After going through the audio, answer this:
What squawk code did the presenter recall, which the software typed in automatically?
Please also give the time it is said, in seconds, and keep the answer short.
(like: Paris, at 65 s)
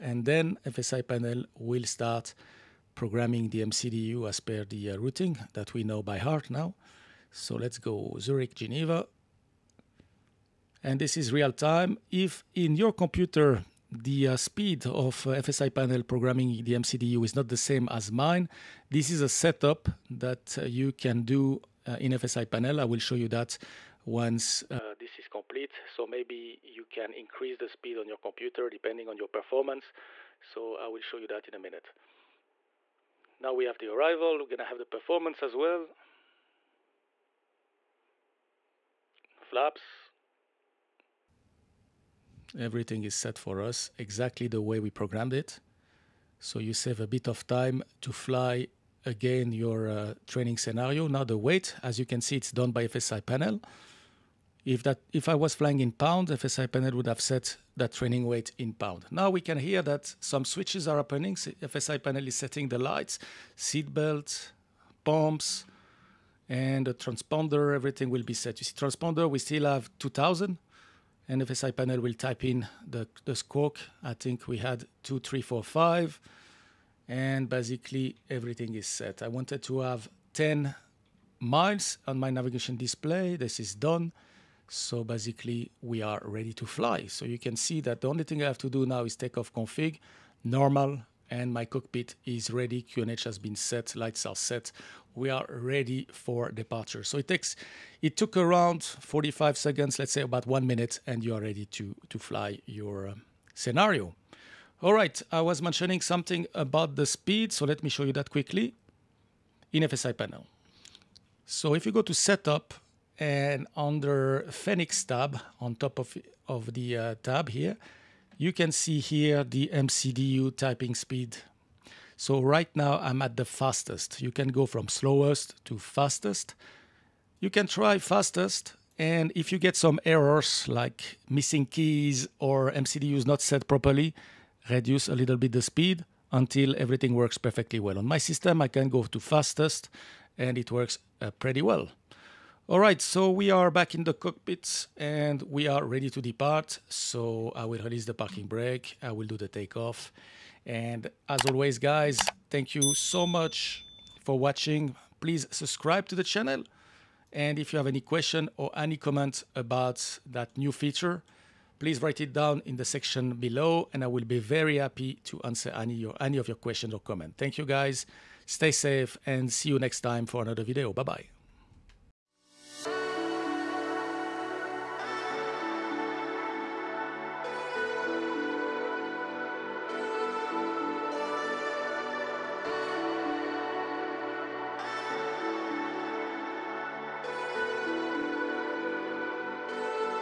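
2345, at 75 s.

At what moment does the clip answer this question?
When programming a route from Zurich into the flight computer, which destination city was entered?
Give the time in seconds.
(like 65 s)
8 s.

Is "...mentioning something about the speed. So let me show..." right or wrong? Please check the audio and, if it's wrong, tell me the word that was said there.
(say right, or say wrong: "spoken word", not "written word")
right.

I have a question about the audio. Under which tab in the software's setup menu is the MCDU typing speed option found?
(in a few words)
Fenix.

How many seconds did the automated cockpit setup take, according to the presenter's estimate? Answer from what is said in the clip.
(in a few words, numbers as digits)
45.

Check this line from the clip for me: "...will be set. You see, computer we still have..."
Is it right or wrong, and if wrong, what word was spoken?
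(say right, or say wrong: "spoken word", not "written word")
wrong: "transponder", not "computer".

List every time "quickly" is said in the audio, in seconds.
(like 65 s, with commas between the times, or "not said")
108 s.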